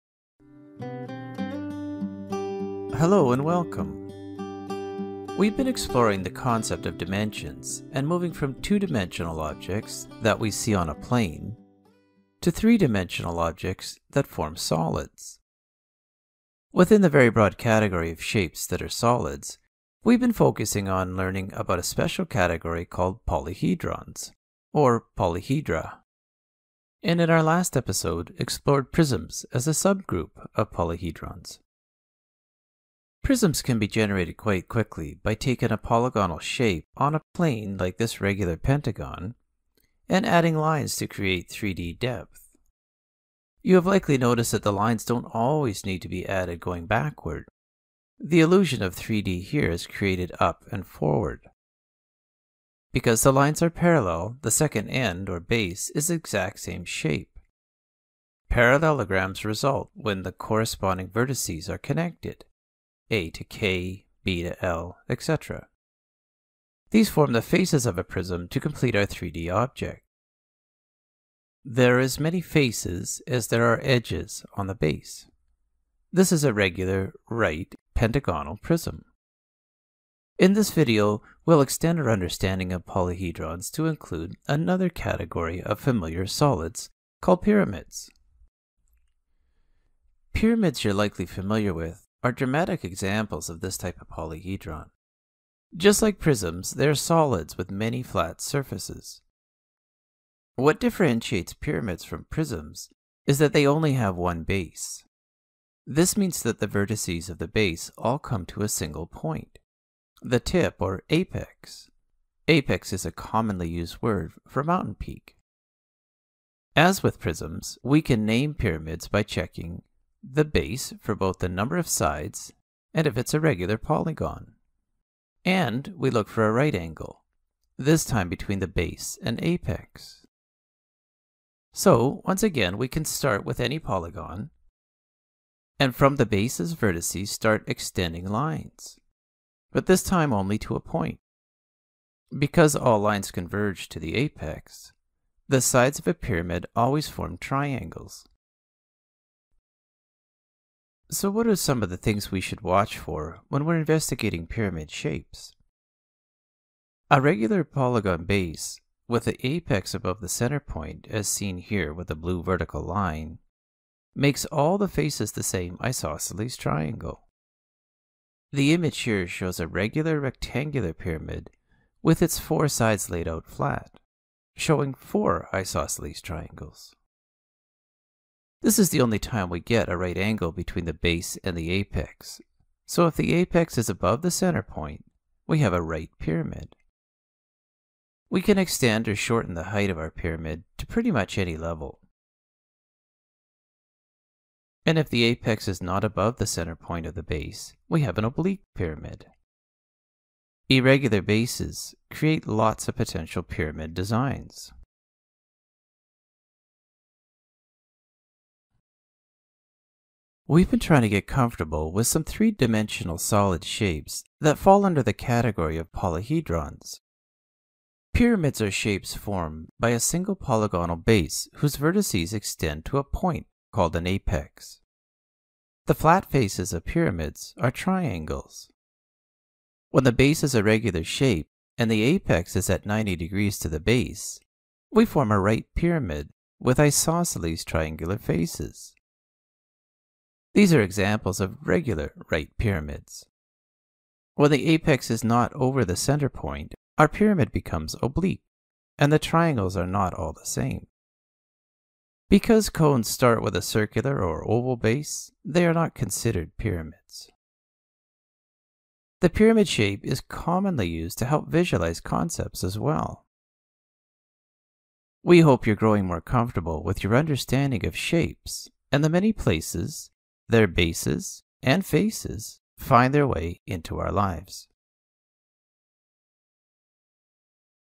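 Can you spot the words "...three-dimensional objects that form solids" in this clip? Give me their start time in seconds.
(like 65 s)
12 s.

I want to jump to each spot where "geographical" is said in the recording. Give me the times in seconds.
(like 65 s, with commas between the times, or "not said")
not said.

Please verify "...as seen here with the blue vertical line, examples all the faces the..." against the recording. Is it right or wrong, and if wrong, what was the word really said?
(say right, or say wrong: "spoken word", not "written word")
wrong: "makes", not "examples".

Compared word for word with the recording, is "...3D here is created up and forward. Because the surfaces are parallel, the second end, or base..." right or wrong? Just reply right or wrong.
wrong.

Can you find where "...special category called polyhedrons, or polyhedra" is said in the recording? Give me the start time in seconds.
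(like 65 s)
21 s.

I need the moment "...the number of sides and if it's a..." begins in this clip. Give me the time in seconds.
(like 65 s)
121 s.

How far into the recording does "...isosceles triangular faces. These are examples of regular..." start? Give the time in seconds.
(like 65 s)
236 s.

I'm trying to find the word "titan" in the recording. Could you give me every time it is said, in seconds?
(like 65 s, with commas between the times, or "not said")
not said.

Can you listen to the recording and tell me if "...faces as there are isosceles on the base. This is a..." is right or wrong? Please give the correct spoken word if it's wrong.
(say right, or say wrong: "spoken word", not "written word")
wrong: "edges", not "isosceles".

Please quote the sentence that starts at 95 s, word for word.
Just like prisms, they are solids with many flat surfaces.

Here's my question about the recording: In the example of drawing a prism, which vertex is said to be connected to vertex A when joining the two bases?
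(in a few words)
K.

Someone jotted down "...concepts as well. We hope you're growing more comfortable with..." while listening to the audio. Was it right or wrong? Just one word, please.
right.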